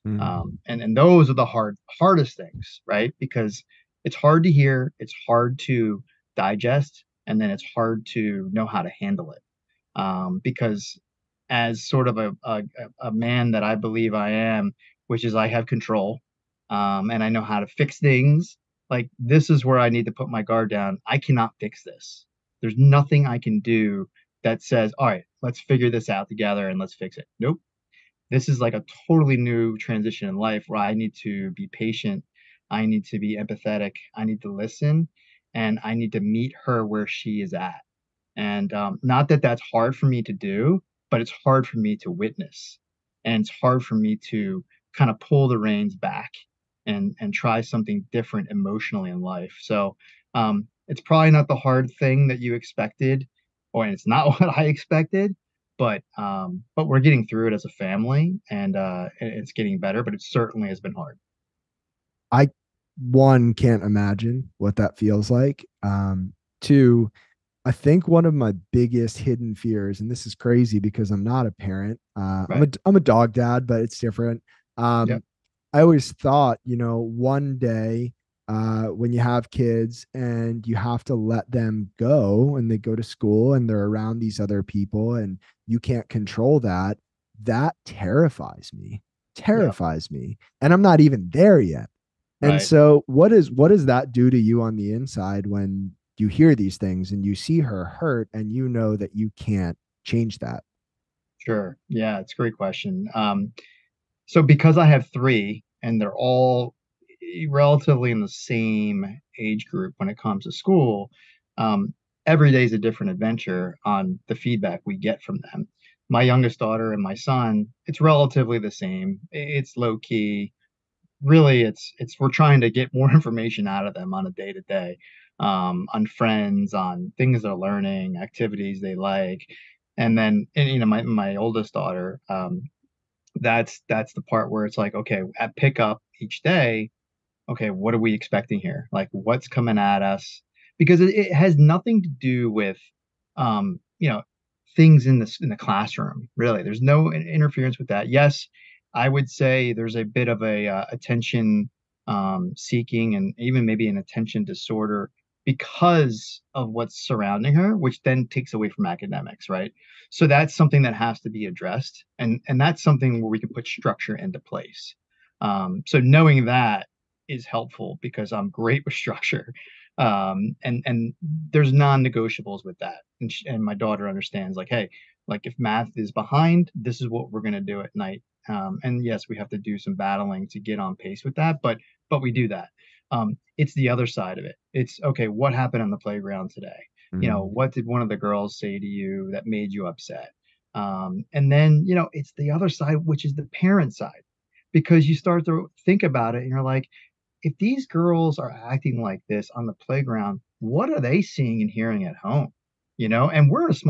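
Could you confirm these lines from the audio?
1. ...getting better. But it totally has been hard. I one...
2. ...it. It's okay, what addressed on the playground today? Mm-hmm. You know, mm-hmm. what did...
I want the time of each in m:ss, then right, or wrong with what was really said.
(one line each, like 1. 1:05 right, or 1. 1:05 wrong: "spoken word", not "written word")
1. 0:59 wrong: "certainly", not "totally"
2. 3:04 wrong: "happened", not "addressed".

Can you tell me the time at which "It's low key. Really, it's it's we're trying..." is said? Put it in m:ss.
1:59.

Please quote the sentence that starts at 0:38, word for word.
And um, not that that's hard for me to do, but it's hard for me to witness.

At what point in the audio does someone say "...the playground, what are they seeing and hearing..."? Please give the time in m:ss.
3:19.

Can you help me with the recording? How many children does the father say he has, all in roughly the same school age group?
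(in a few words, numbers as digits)
3.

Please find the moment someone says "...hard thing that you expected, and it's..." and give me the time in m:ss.
0:51.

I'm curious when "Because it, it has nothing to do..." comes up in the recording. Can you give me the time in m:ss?
2:20.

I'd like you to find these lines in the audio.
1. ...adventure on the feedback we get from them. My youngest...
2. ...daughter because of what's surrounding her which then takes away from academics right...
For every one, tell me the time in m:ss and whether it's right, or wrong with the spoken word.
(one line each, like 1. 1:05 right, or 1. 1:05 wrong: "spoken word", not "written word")
1. 1:53 right
2. 2:34 wrong: "disorder", not "daughter".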